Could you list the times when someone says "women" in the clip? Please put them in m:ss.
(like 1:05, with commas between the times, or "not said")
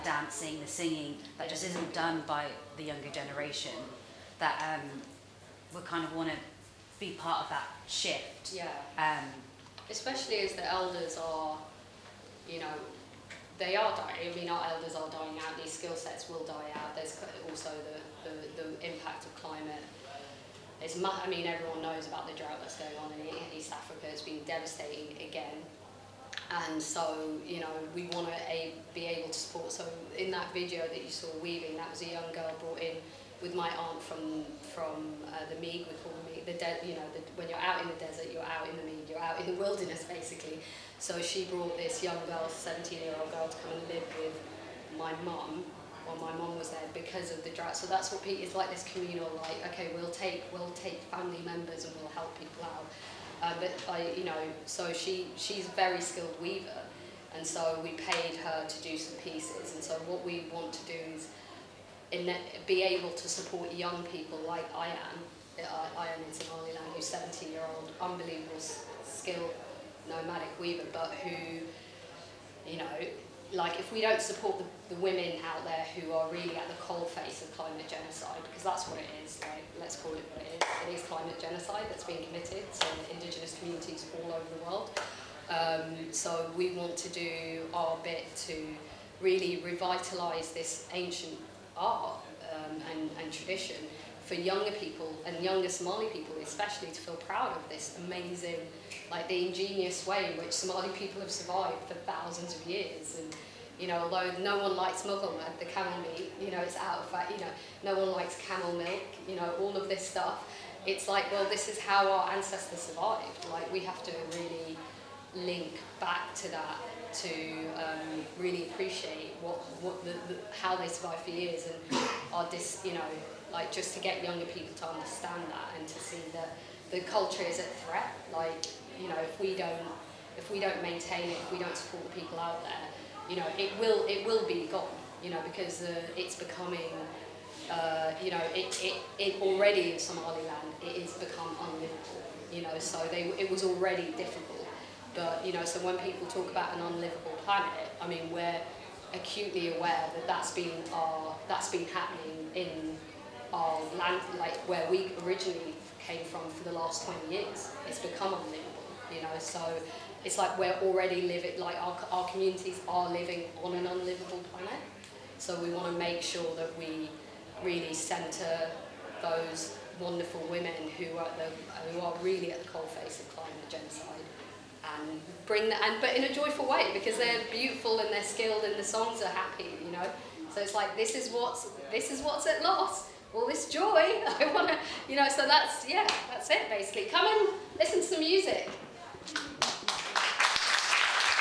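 1:14, 2:50.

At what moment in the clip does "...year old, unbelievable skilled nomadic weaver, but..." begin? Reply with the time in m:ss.
1:07.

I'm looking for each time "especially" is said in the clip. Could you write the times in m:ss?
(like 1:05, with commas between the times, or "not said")
0:09, 1:36.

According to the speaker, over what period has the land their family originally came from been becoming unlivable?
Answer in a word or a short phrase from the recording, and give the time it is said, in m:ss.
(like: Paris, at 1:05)
The last 20 years, at 2:36.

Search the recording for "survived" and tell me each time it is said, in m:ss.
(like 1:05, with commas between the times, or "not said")
1:41, 1:52, 2:00.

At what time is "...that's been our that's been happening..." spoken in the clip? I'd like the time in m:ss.
2:30.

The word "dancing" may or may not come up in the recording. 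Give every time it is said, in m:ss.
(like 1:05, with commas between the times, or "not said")
0:00.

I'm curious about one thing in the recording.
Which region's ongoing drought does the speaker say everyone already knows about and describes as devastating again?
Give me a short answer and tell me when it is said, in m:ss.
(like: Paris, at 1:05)
East Africa, at 0:23.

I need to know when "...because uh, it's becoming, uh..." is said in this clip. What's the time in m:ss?
2:15.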